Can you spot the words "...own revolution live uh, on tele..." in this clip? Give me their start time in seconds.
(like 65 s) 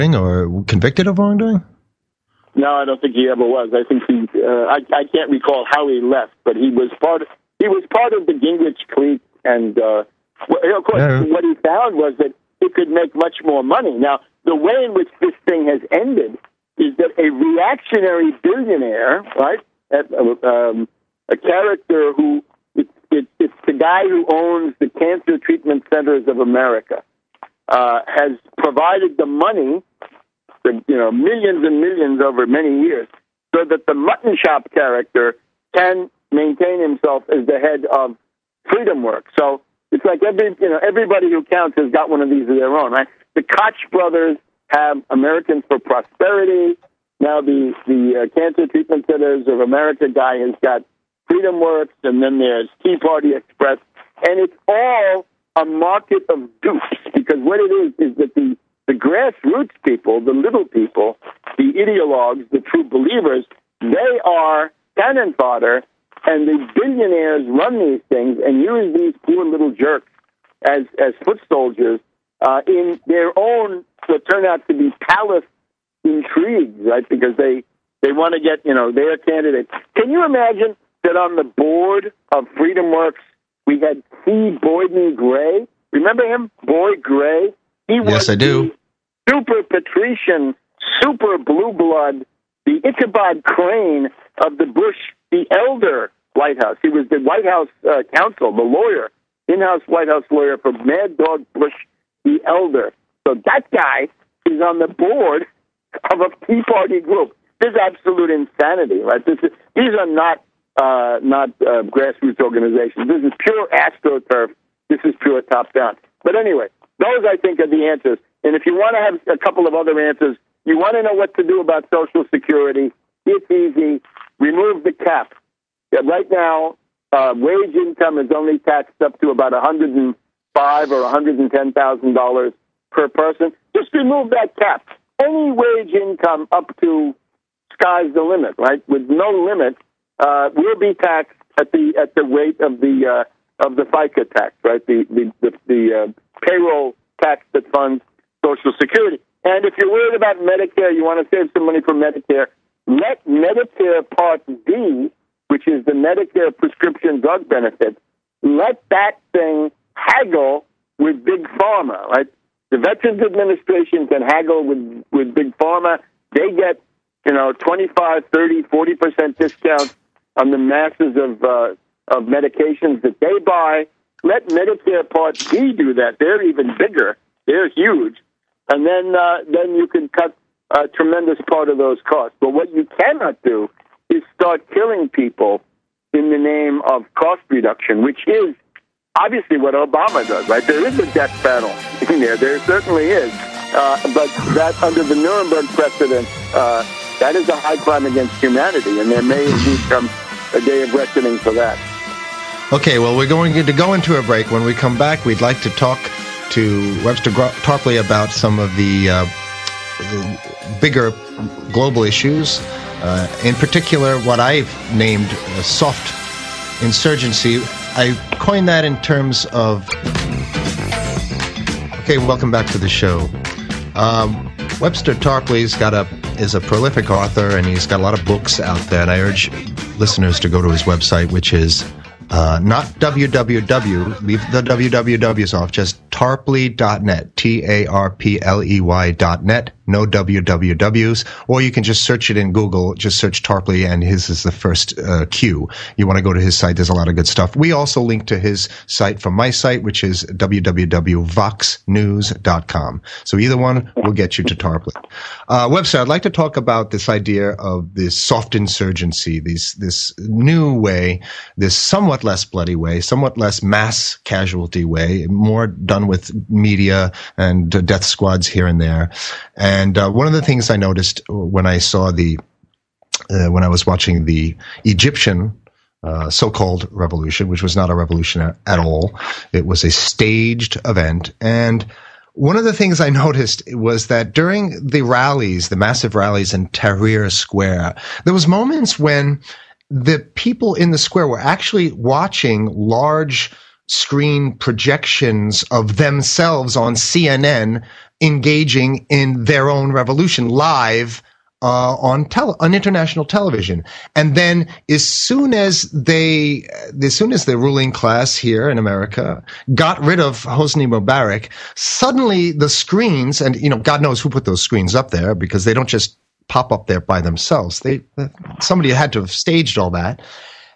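299 s.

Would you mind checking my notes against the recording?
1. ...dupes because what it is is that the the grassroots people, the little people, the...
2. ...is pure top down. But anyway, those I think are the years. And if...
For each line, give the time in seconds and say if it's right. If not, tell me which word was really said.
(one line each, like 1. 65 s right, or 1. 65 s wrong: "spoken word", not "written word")
1. 56 s right
2. 115 s wrong: "answers", not "years".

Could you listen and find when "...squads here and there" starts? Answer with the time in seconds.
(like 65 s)
268 s.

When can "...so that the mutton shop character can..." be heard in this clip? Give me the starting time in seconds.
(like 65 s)
33 s.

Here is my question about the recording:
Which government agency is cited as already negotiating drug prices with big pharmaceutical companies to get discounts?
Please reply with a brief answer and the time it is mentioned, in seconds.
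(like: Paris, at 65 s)
Veterans Administration, at 162 s.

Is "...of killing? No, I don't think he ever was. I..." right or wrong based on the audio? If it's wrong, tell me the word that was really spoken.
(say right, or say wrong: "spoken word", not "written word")
wrong: "wrongdoing", not "killing".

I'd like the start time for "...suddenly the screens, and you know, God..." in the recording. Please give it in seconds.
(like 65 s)
311 s.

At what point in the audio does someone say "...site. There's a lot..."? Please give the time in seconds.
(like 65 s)
246 s.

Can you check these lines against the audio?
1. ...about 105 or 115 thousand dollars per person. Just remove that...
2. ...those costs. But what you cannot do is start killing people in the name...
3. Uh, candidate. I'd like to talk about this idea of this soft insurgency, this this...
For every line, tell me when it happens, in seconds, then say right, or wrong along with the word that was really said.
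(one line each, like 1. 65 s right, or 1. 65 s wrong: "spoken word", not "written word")
1. 129 s wrong: "110", not "115"
2. 181 s right
3. 255 s wrong: "website", not "candidate".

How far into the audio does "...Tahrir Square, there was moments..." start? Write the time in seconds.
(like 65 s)
286 s.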